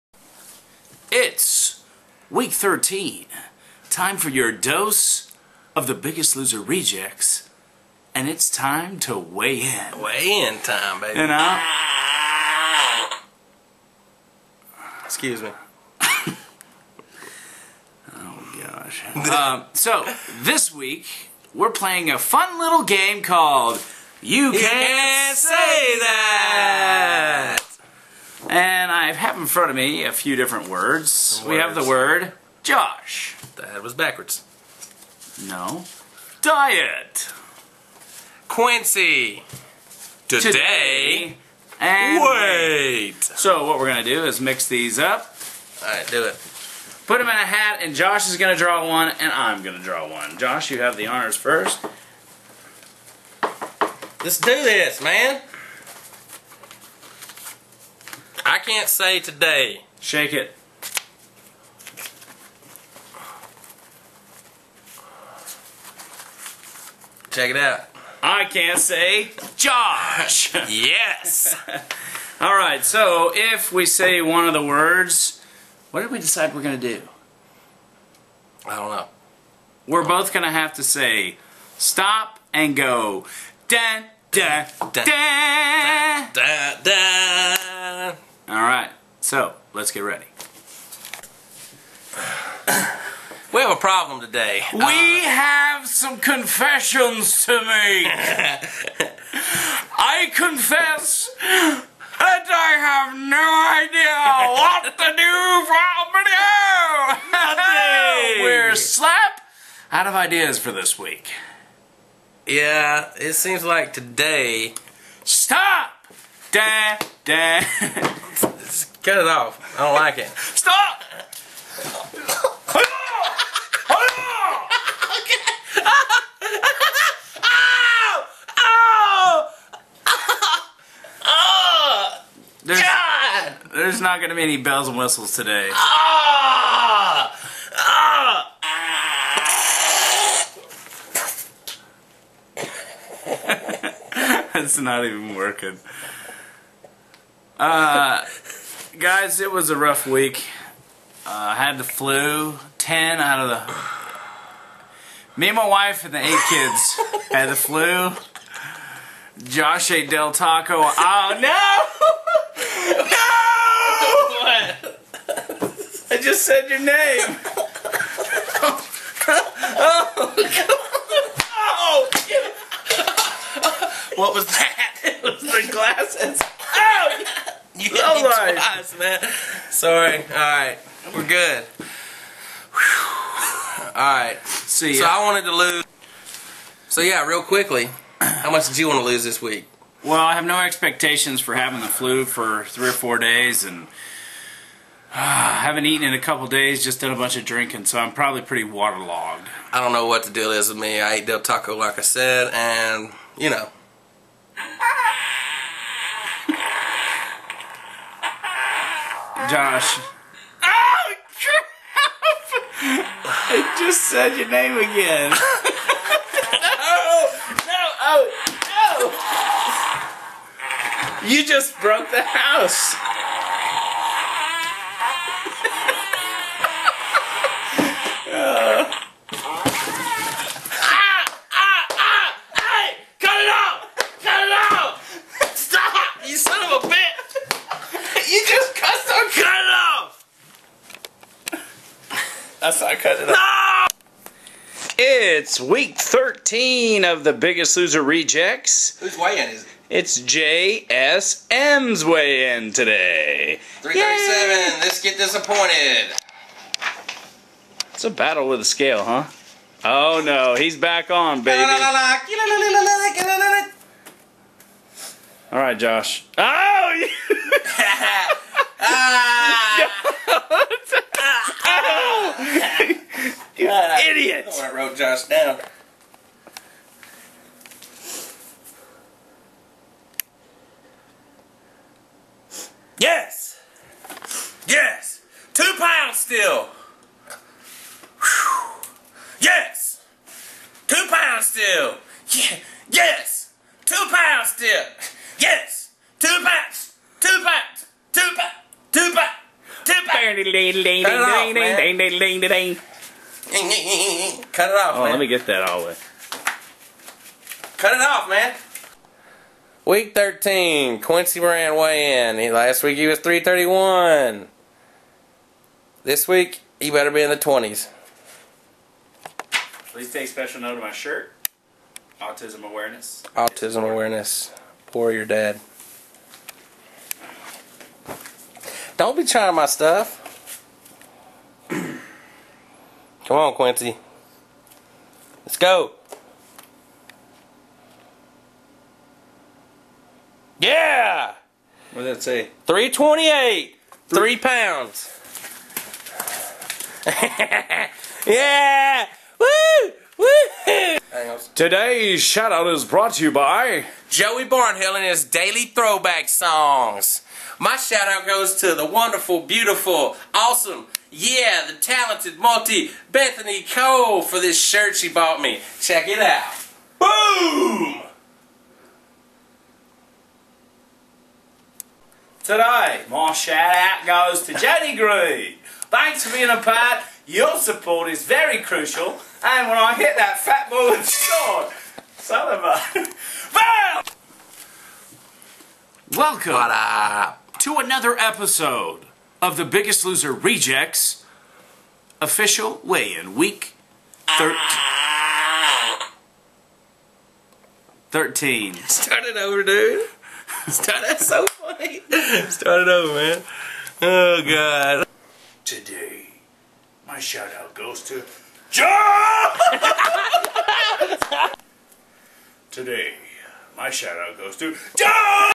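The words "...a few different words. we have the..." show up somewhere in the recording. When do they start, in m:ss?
0:30.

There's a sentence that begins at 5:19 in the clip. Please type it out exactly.
Please take special note of my shirt.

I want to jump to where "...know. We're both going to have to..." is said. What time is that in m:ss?
1:18.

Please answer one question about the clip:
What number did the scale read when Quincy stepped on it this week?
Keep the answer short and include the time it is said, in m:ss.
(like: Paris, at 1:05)
328, at 5:42.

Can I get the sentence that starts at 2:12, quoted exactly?
There's, there's not going to be any bells and whistles today.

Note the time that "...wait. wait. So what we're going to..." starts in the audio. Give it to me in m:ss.
0:42.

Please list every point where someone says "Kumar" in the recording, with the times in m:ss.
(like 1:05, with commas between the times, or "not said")
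not said.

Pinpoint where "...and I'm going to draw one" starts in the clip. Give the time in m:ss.
0:49.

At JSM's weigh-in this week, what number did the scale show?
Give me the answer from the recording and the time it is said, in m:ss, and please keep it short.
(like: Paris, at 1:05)
337, at 4:13.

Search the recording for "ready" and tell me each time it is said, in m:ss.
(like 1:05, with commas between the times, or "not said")
1:30.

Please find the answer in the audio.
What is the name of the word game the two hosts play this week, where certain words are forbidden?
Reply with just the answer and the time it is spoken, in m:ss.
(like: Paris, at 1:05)
You Can't Say That, at 0:24.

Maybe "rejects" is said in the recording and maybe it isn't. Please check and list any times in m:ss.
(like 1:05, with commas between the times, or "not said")
0:06, 4:08, 6:30.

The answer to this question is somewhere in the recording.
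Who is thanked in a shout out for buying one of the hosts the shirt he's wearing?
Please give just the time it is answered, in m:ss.
6:03.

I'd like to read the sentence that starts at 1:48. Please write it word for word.
We're slap out of ideas for this week.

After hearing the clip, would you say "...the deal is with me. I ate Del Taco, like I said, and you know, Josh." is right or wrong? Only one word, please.
right.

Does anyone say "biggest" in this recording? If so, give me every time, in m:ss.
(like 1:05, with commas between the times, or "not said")
0:05, 4:07, 6:29.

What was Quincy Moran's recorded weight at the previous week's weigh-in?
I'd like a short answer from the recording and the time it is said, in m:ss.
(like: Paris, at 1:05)
331, at 5:13.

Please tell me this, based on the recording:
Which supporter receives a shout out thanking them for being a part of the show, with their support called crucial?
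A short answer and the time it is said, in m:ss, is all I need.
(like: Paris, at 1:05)
Jenny Green, at 6:14.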